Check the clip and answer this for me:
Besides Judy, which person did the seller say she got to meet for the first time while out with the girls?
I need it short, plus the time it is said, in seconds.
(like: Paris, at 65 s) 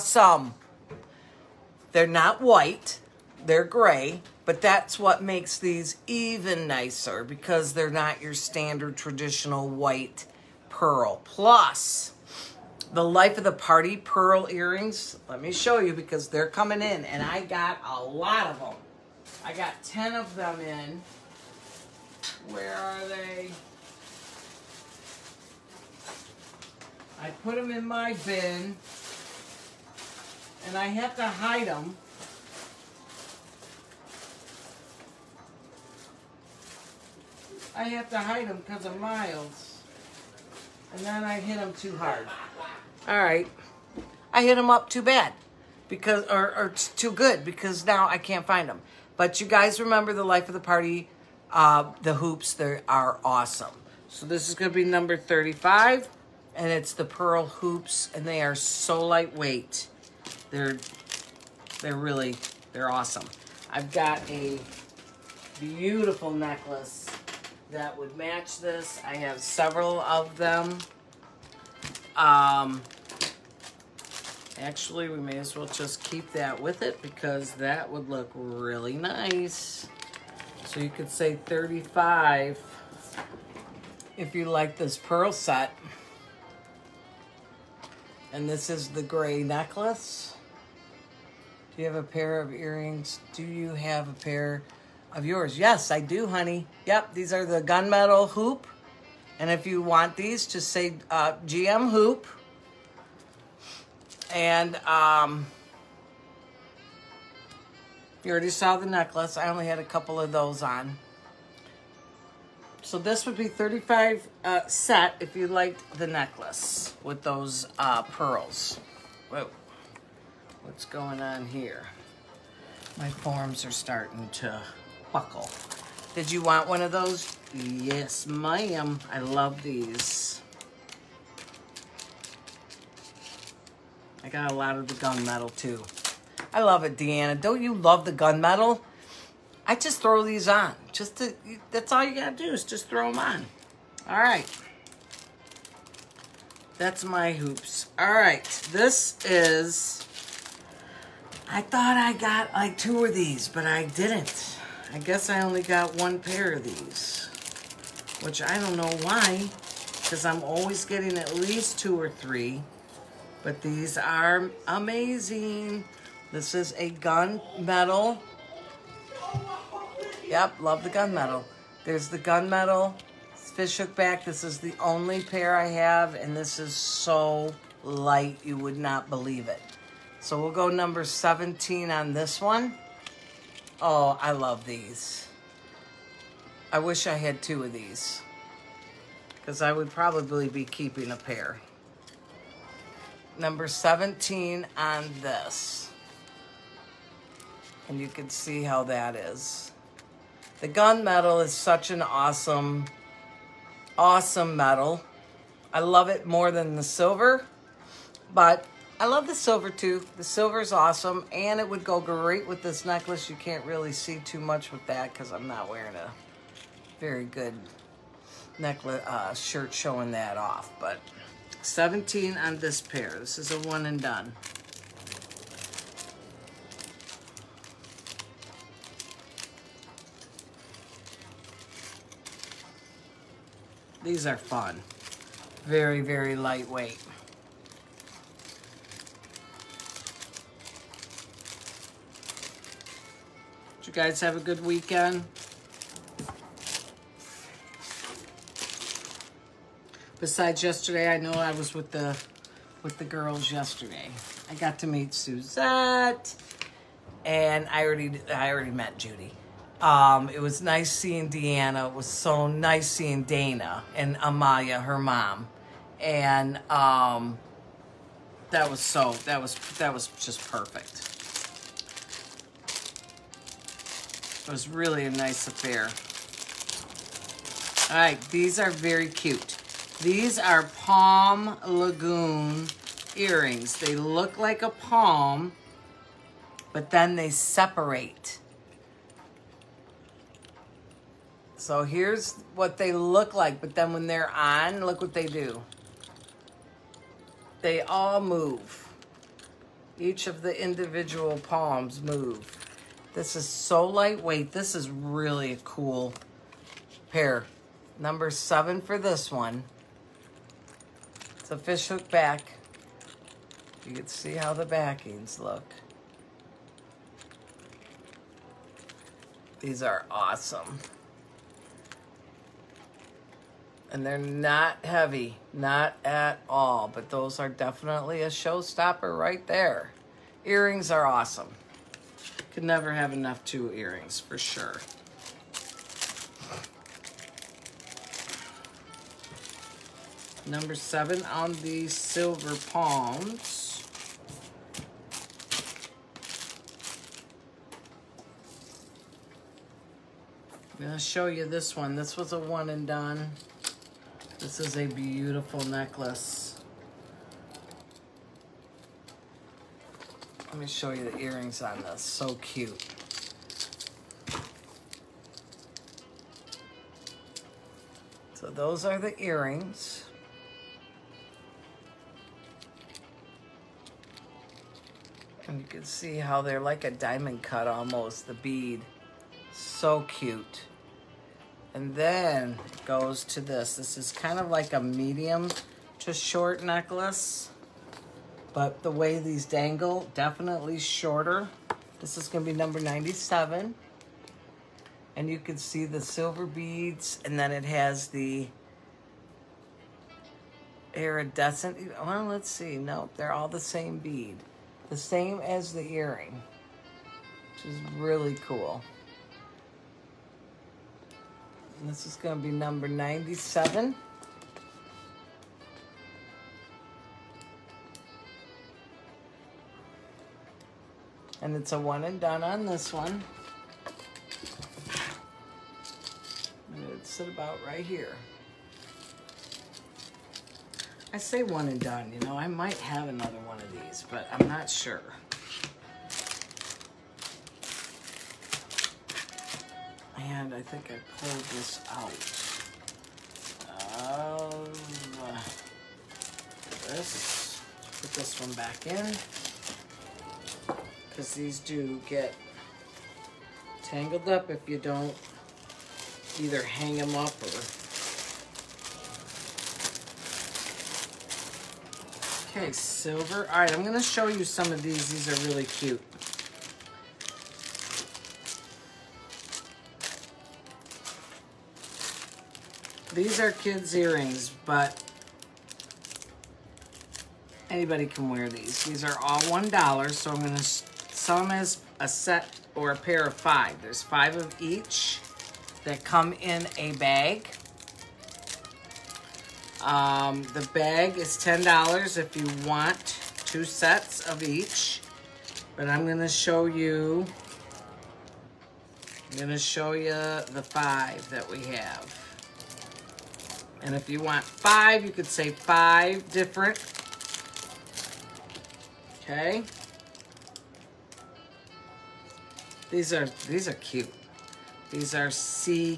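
Suzette, at 254 s.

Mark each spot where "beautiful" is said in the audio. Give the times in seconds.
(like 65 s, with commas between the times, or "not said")
65 s, 354 s.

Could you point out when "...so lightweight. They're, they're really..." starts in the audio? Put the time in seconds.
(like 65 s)
58 s.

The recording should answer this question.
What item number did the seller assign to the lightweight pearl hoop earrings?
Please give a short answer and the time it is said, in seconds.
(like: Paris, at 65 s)
35, at 54 s.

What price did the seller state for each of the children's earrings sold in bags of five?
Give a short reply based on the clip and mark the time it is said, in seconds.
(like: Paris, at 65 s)
$1, at 478 s.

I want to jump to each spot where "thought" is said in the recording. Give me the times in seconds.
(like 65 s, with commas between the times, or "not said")
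151 s.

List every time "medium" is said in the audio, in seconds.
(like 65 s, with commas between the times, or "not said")
384 s.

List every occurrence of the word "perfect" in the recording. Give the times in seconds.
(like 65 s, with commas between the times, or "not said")
270 s.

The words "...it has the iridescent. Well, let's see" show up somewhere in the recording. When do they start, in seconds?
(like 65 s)
397 s.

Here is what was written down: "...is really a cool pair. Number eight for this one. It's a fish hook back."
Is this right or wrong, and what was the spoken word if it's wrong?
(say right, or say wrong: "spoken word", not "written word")
wrong: "seven", not "eight".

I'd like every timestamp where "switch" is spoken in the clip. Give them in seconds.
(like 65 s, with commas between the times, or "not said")
not said.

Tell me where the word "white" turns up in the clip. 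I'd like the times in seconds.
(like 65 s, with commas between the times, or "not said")
2 s, 9 s.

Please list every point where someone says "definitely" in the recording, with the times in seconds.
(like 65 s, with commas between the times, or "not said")
327 s, 390 s.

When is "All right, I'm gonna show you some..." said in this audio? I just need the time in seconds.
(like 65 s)
463 s.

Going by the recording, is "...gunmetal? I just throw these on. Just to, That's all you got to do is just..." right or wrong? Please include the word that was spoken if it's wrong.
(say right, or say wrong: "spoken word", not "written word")
right.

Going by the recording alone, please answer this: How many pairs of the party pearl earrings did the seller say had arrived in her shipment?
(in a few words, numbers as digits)
10.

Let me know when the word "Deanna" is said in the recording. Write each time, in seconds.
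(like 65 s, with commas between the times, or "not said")
136 s, 261 s.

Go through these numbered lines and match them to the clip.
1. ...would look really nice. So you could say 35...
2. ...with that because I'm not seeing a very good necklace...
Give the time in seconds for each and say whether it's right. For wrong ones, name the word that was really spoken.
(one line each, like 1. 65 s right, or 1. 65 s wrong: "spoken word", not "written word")
1. 77 s right
2. 214 s wrong: "wearing", not "seeing".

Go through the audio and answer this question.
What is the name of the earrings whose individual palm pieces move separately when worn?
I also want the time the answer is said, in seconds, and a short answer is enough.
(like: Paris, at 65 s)
Palm Lagoon, at 280 s.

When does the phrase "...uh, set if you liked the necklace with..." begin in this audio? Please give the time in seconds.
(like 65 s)
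114 s.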